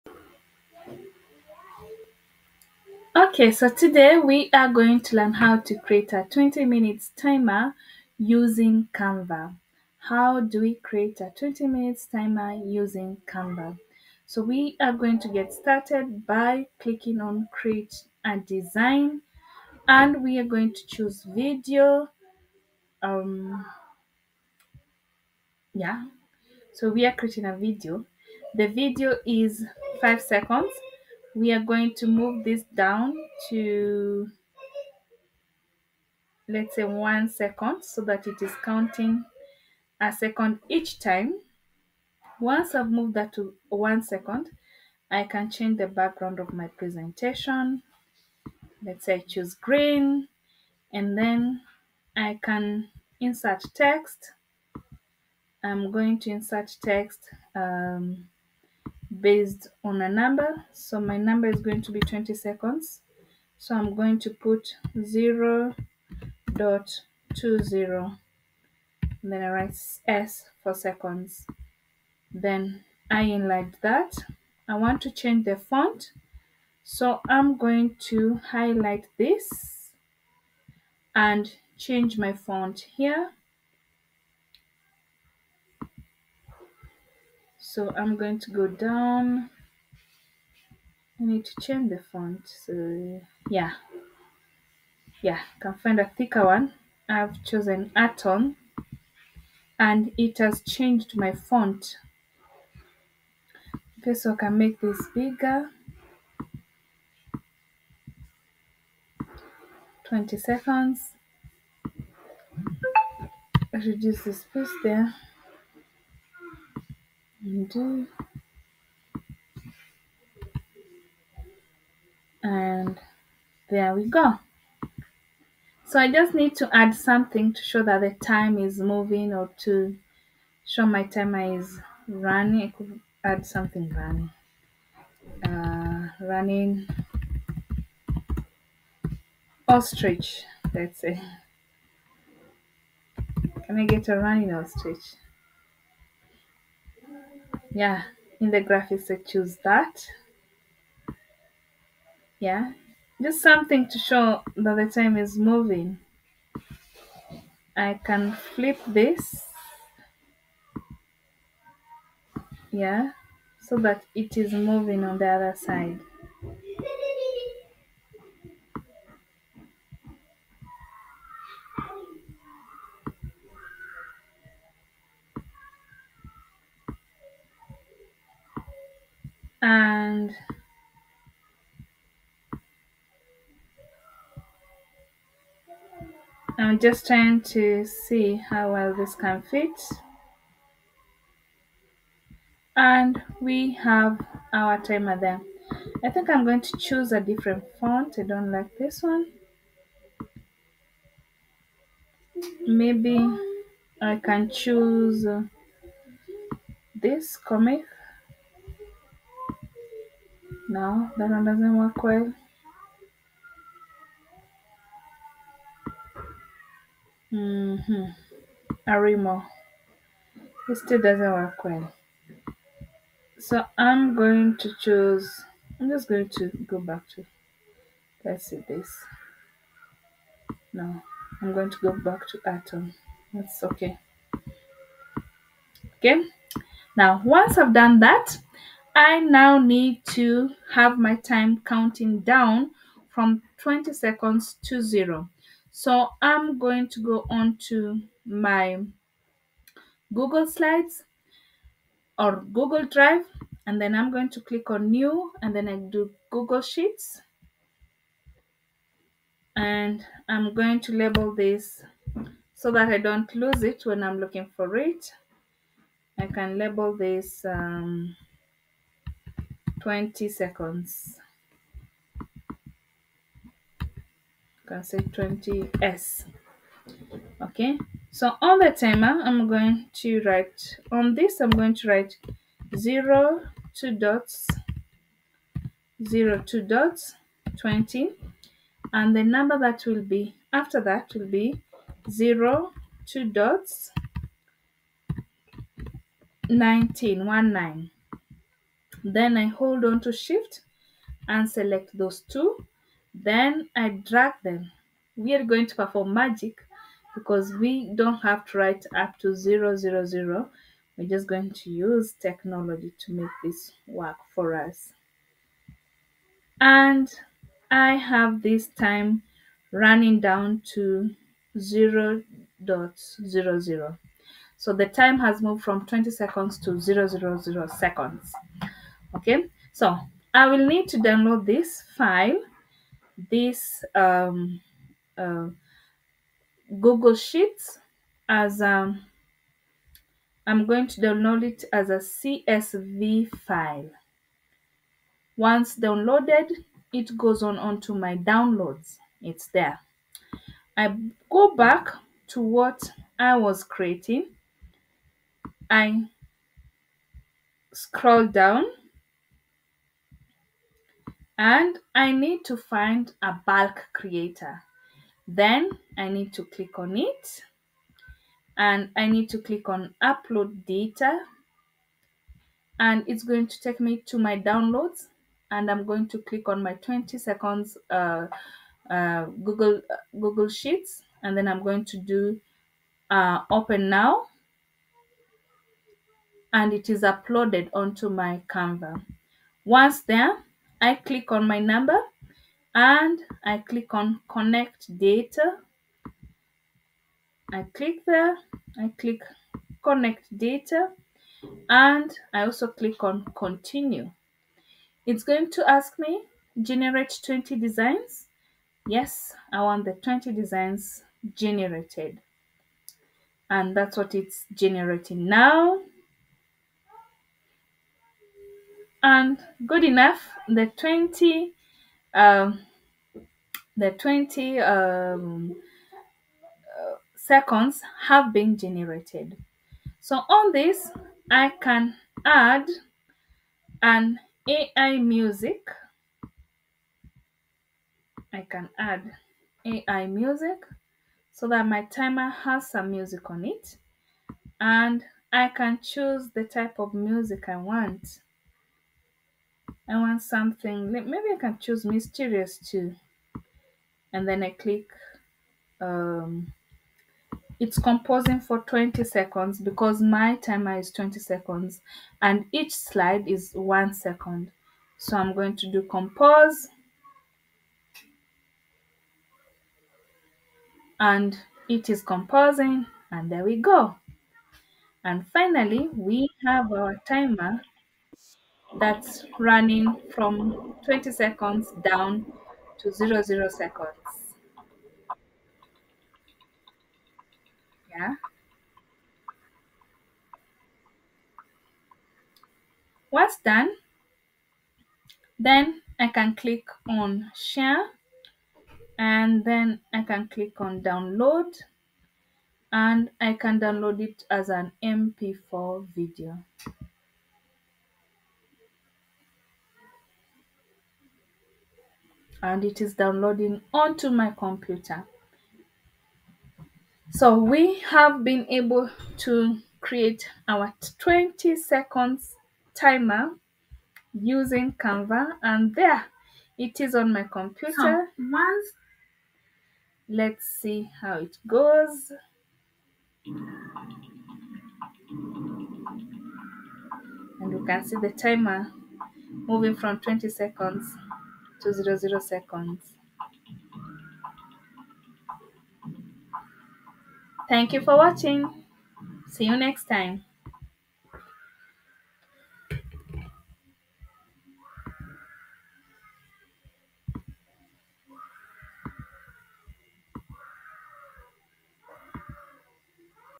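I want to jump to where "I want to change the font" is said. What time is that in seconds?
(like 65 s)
74 s.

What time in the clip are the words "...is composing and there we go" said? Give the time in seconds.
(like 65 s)
471 s.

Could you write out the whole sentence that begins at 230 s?
No, I'm going to go back to Anton.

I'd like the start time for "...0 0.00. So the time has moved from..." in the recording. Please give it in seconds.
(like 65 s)
321 s.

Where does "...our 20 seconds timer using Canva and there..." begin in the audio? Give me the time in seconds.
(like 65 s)
520 s.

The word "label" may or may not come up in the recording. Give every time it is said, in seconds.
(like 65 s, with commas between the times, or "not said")
260 s, 266 s.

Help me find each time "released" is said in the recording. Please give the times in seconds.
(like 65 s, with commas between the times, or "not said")
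not said.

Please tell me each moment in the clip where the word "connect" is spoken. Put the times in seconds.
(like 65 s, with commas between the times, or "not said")
394 s, 399 s.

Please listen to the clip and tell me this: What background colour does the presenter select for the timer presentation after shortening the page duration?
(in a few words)
Green.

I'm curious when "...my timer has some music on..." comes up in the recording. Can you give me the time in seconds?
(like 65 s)
441 s.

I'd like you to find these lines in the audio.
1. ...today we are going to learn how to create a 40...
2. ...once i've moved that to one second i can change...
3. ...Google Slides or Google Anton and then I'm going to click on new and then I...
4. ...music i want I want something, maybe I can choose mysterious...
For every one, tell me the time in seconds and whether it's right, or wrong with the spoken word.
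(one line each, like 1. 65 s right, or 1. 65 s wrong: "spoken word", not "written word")
1. 3 s wrong: "20", not "40"
2. 42 s right
3. 250 s wrong: "Drive", not "Anton"
4. 446 s right.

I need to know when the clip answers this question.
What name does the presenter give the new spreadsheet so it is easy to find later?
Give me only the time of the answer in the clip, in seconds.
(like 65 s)
274 s.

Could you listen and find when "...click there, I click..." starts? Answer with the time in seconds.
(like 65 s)
397 s.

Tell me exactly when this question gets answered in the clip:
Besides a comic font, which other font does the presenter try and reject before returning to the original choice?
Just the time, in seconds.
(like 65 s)
218 s.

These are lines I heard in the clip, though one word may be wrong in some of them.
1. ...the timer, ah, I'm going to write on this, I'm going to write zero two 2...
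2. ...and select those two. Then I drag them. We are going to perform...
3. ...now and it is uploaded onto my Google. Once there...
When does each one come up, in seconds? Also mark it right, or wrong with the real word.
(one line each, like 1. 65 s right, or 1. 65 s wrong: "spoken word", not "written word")
1. 278 s right
2. 301 s right
3. 383 s wrong: "Canva", not "Google".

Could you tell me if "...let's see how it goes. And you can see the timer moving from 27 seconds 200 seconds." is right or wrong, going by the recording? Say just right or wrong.
wrong.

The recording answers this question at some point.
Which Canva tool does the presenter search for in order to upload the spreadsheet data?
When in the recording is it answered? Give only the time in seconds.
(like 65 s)
363 s.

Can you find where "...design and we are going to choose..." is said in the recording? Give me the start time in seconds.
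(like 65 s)
18 s.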